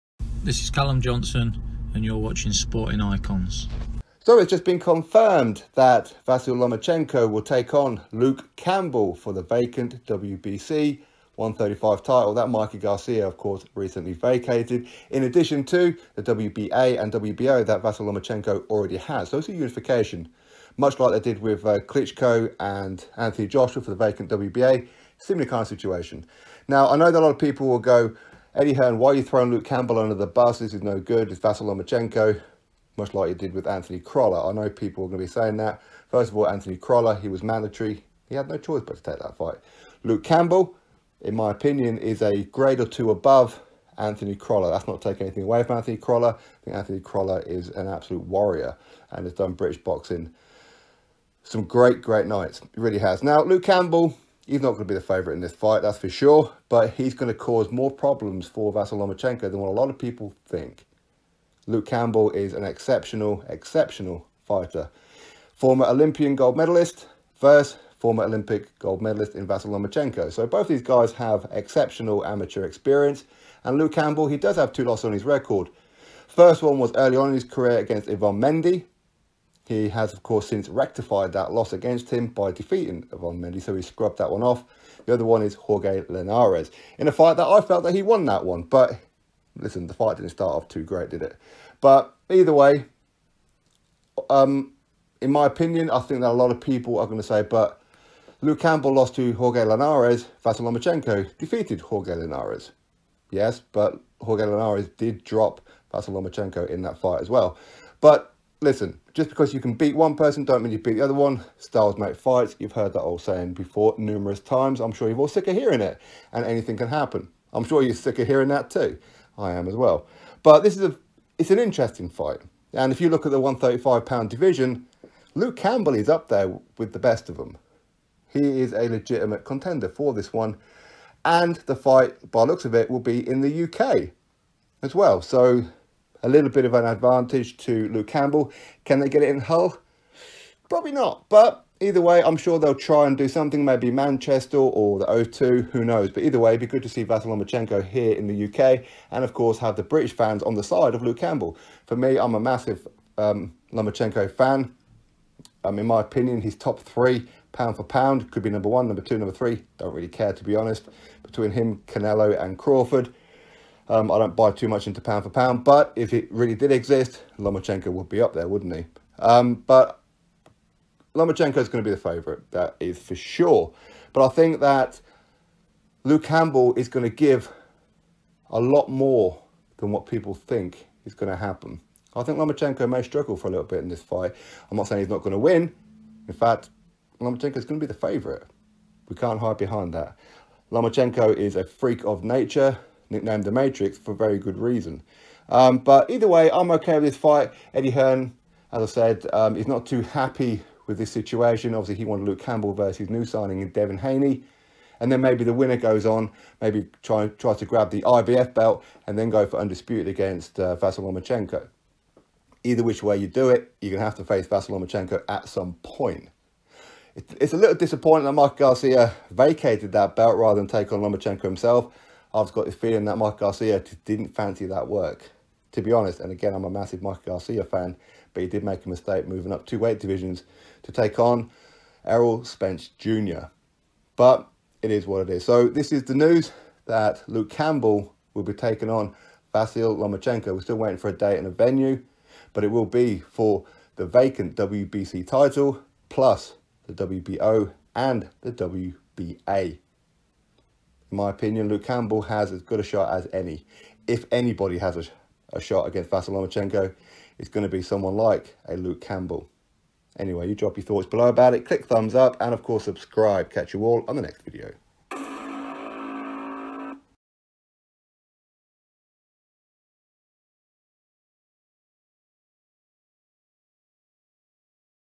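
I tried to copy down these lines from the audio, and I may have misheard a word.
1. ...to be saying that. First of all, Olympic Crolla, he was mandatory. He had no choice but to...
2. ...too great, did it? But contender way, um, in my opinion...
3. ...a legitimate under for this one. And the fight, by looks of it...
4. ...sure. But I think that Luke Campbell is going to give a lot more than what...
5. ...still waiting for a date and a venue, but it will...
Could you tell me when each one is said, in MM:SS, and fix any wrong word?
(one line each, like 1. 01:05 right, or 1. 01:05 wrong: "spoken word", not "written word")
1. 00:35 wrong: "Anthony", not "Olympic"
2. 01:30 wrong: "either", not "contender"
3. 02:08 wrong: "contender", not "under"
4. 02:53 right
5. 04:00 right.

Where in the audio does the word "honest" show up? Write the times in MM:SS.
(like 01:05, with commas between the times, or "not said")
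02:40, 03:45.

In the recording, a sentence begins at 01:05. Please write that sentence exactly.
Former Olympian gold medalist versus former Olympic gold medalist in Vasyl Lomachenko.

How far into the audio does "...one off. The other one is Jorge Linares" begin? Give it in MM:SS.
01:24.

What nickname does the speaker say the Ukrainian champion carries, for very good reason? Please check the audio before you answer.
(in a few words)
The Matrix.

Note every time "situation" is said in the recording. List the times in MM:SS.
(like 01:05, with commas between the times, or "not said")
00:25, 03:21.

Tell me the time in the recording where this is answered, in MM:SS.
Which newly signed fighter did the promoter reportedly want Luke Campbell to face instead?
03:23.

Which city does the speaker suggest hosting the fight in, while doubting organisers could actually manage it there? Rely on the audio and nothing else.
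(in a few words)
Hull.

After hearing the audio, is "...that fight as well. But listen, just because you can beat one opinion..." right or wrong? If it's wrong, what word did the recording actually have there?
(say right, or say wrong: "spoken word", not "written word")
wrong: "person", not "opinion".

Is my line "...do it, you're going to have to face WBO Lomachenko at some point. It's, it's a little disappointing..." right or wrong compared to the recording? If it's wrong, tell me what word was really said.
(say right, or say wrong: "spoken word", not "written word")
wrong: "Vasyl", not "WBO".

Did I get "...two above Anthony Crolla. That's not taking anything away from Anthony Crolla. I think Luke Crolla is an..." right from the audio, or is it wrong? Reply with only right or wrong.
wrong.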